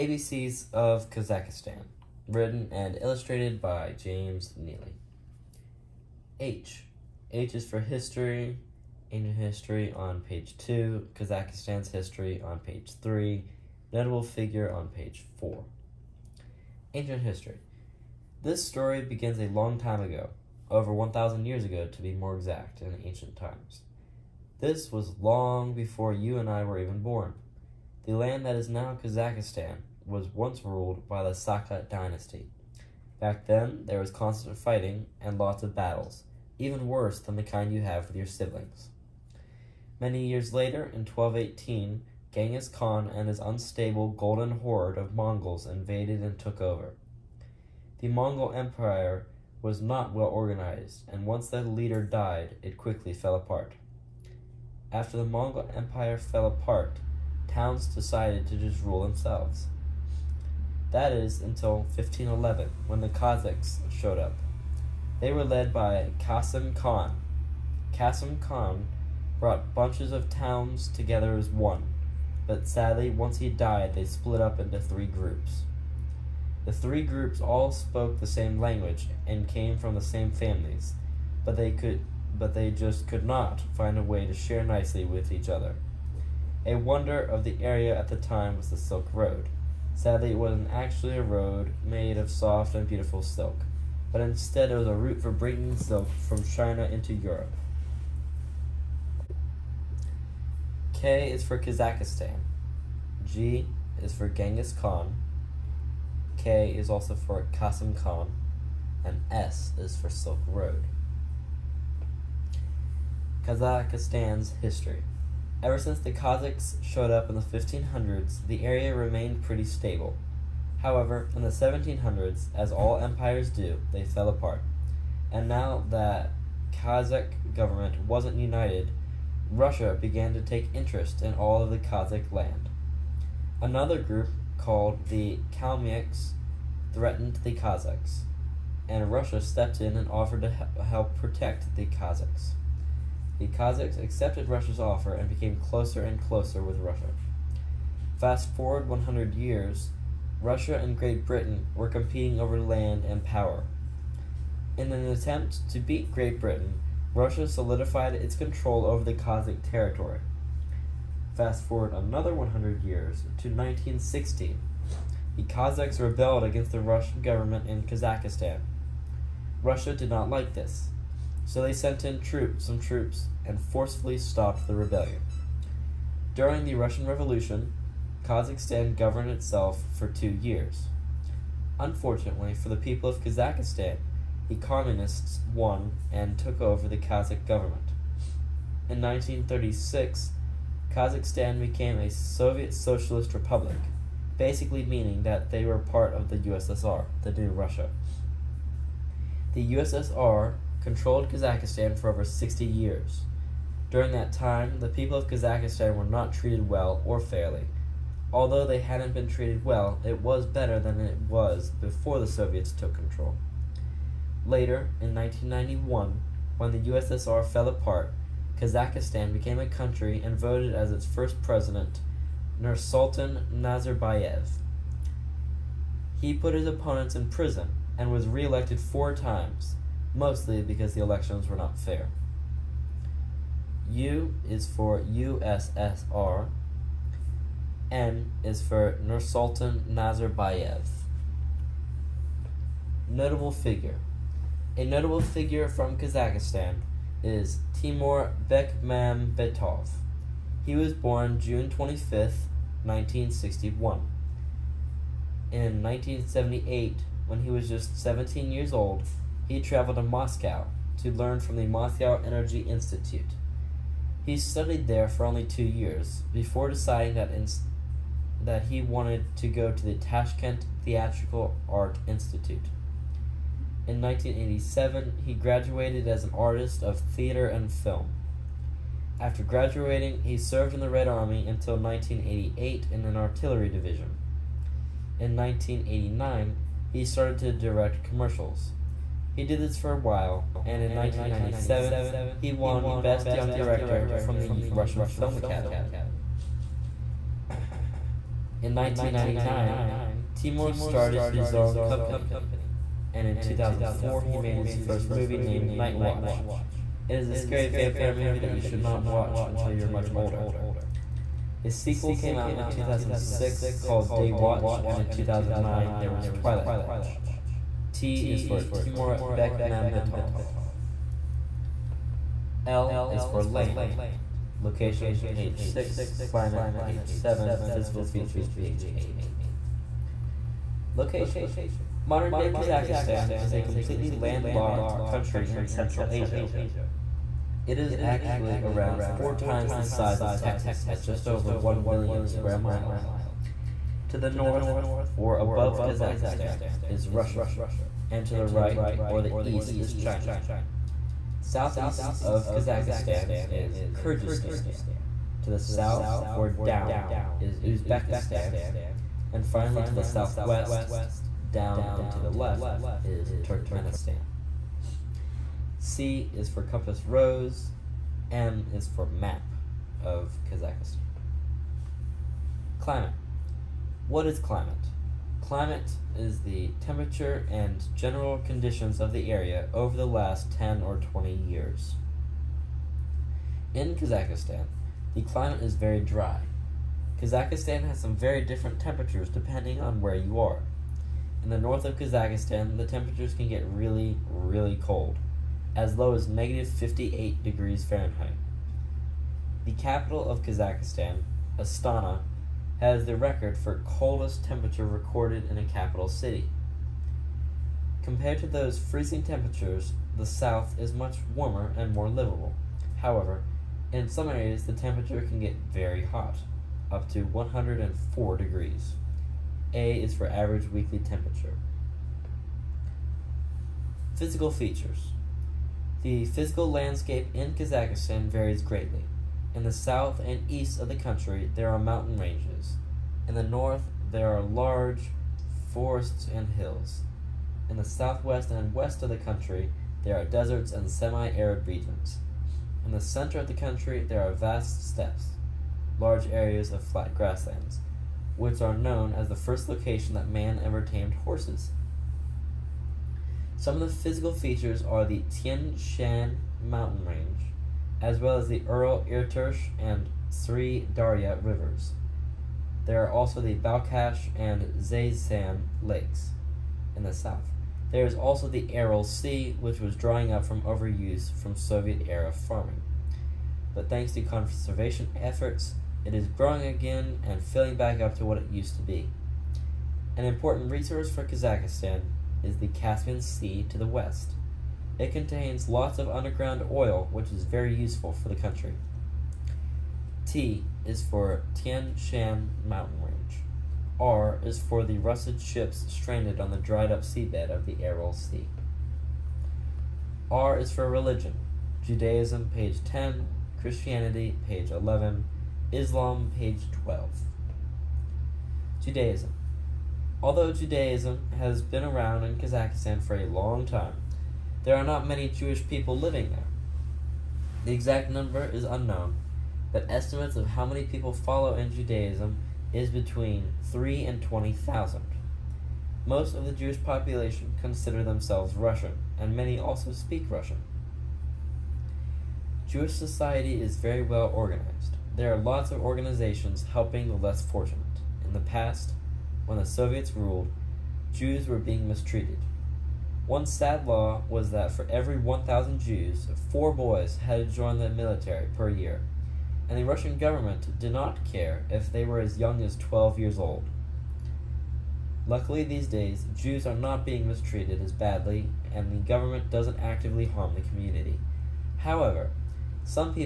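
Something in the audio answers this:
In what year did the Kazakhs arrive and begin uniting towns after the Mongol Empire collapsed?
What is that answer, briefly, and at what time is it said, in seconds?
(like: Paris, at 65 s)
1511, at 61 s.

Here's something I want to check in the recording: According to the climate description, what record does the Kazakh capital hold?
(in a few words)
coldest temperature recorded in a capital city.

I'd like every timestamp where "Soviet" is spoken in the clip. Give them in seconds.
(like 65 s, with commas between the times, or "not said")
192 s, 212 s, 471 s, 539 s.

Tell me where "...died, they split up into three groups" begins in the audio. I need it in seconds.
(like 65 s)
73 s.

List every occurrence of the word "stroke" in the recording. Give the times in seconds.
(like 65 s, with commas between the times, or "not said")
not said.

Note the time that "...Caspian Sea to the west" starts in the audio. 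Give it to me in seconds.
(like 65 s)
482 s.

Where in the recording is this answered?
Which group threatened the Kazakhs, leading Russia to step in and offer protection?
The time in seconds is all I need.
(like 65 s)
135 s.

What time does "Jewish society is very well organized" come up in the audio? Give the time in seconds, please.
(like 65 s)
532 s.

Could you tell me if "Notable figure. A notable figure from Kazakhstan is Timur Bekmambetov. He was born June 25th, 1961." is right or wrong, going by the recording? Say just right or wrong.
right.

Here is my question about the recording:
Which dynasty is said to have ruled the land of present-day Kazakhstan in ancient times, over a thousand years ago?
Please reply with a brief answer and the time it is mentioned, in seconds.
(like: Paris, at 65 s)
Saka dynasty, at 31 s.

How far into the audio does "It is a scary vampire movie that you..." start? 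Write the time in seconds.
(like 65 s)
307 s.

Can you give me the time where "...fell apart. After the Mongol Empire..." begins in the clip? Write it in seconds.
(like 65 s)
53 s.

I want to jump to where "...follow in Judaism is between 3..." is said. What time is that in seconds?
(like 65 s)
521 s.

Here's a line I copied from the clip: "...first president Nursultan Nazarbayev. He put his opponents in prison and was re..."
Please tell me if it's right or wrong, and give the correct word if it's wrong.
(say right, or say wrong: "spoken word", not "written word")
right.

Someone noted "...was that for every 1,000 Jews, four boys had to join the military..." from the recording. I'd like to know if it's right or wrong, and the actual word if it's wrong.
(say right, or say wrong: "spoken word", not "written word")
right.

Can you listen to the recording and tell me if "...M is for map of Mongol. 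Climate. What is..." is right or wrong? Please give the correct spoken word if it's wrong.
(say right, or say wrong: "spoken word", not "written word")
wrong: "Kazakhstan", not "Mongol".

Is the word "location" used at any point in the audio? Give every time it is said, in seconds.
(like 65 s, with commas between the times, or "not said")
324 s, 330 s, 449 s.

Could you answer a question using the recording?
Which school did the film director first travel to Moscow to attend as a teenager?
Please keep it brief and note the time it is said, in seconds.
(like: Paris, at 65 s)
Moscow Energy Institute, at 261 s.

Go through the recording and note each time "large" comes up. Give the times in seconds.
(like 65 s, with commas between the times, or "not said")
434 s, 445 s.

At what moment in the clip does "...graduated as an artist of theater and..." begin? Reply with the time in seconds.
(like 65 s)
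275 s.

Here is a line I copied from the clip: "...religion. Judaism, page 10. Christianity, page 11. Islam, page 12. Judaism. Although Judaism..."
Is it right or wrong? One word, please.
right.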